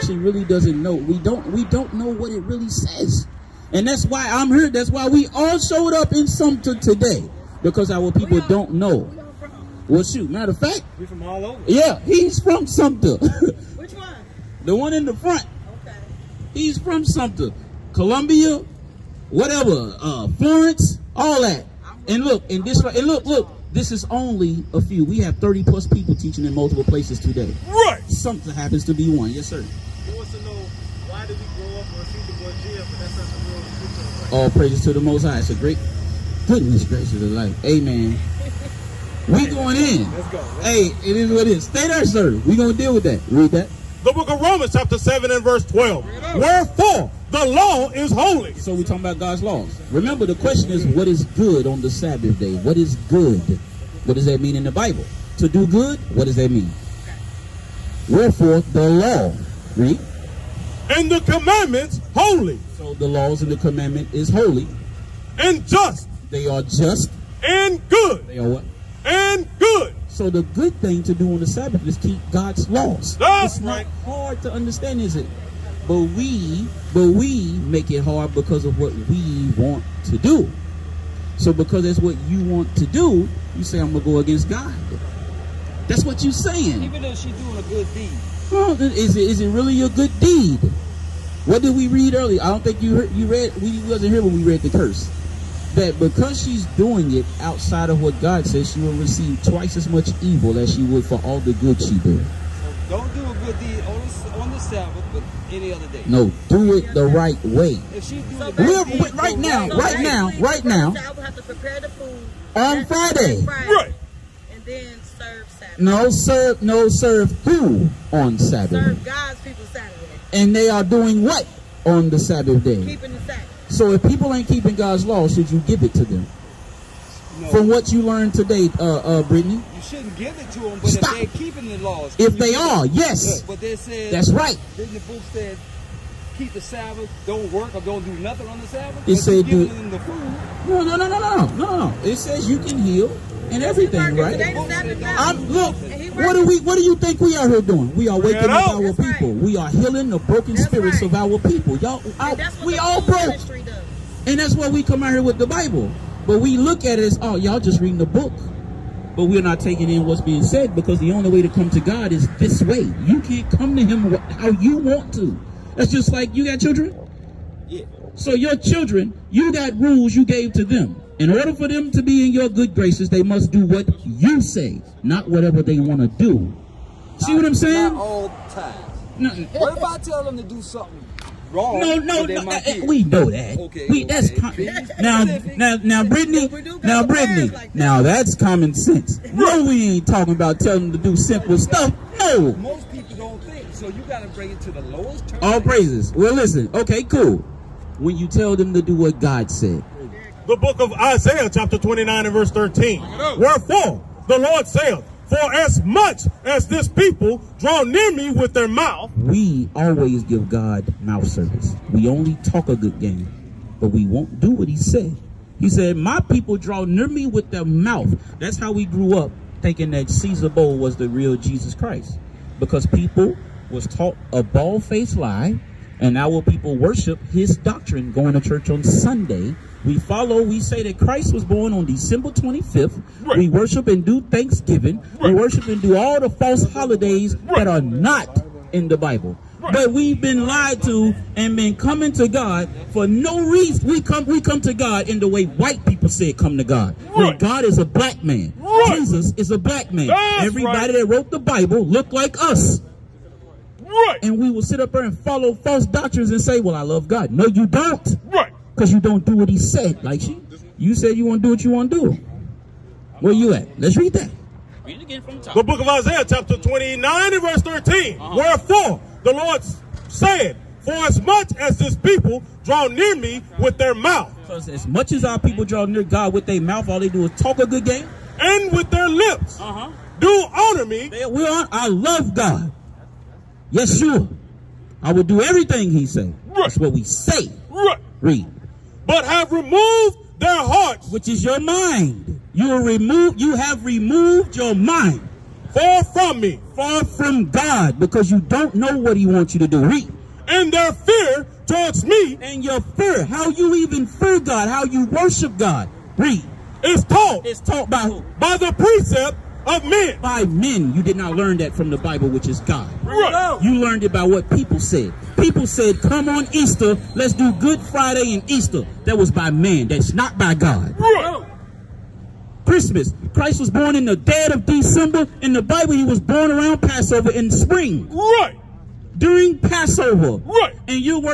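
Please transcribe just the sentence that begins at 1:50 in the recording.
I will have to prepare the food on Friday.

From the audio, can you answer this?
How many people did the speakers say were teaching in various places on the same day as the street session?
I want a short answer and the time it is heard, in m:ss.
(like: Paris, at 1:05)
30 plus, at 0:25.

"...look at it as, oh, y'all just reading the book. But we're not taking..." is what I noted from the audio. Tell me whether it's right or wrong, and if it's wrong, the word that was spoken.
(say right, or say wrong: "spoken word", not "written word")
right.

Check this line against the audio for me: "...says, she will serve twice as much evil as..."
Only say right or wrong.
wrong.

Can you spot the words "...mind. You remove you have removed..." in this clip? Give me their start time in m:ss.
4:51.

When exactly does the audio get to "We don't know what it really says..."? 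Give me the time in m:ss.
0:01.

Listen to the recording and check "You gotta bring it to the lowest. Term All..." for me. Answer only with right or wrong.
right.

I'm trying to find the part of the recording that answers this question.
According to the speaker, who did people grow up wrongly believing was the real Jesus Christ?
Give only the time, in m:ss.
3:40.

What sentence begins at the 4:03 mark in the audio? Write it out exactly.
We come we come to God in the way white people it.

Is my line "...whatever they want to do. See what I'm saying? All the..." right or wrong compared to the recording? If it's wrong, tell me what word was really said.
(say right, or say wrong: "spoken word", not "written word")
right.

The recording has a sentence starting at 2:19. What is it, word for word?
It said, do, No, no, no, no, no, no, It says you can heal and everything, right?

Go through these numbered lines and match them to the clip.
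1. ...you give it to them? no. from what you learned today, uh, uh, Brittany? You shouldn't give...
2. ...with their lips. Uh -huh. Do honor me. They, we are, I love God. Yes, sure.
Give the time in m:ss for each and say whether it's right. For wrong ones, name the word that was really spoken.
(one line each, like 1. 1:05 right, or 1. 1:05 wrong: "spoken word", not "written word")
1. 2:05 right
2. 4:38 right.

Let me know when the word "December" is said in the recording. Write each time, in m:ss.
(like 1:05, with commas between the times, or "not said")
3:51, 5:24.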